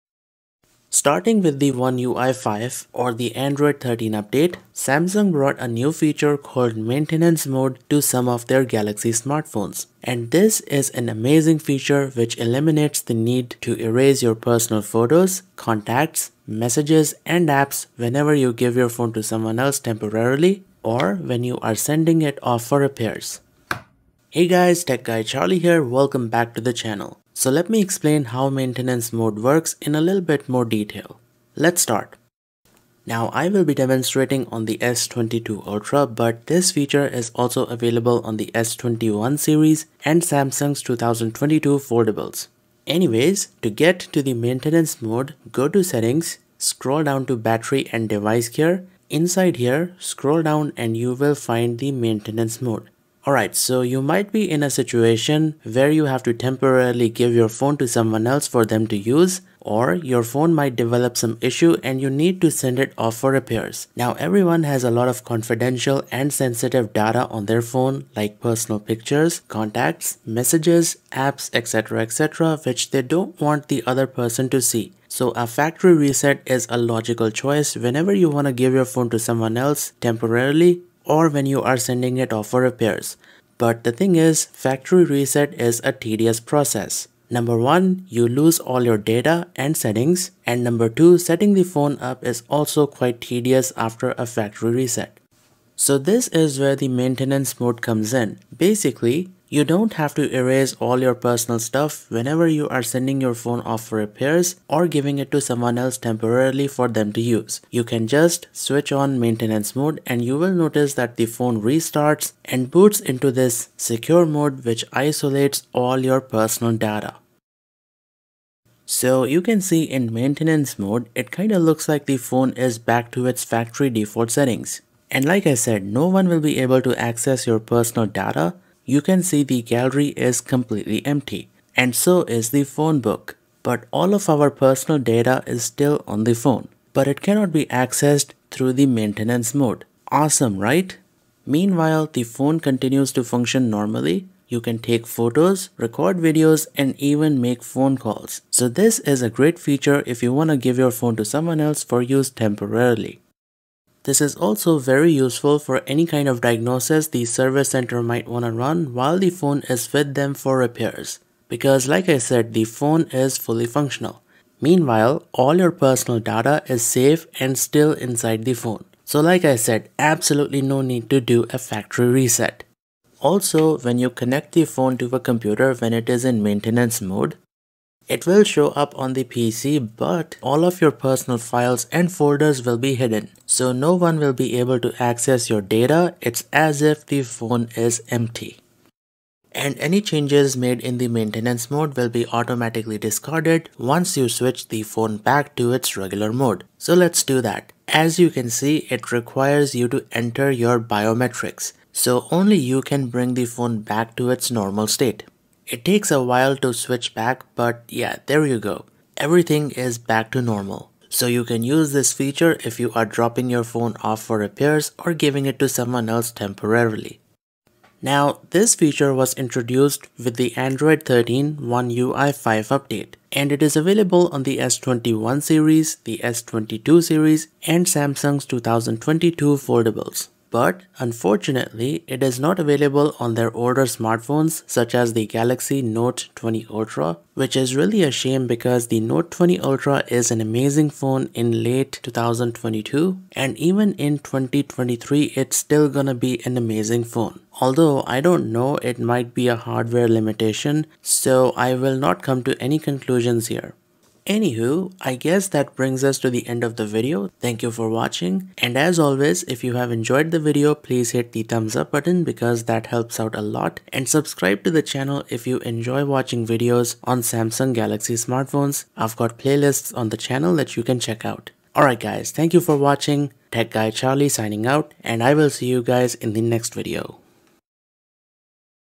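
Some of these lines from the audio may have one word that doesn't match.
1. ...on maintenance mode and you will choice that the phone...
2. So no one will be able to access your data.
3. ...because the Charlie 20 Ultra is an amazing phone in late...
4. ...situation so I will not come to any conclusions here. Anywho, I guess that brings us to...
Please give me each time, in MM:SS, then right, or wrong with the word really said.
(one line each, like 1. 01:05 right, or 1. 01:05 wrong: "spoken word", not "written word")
1. 01:48 wrong: "notice", not "choice"
2. 03:03 right
3. 03:58 wrong: "Note", not "Charlie"
4. 04:10 wrong: "limitation", not "situation".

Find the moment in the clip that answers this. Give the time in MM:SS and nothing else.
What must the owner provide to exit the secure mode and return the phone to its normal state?
03:20.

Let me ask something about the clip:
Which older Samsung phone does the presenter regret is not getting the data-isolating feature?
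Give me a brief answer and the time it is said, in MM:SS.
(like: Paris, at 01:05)
Galaxy Note 20 Ultra, at 03:55.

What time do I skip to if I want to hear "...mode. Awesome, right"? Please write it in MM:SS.
02:19.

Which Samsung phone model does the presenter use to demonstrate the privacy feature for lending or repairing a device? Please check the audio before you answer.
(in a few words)
S22 Ultra.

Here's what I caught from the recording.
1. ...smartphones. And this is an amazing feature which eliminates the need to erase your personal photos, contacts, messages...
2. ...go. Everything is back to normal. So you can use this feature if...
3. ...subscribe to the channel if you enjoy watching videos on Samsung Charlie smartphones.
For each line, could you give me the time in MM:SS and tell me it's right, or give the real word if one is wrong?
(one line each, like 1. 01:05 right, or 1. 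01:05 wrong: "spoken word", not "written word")
1. 00:09 right
2. 03:28 right
3. 04:24 wrong: "Galaxy", not "Charlie".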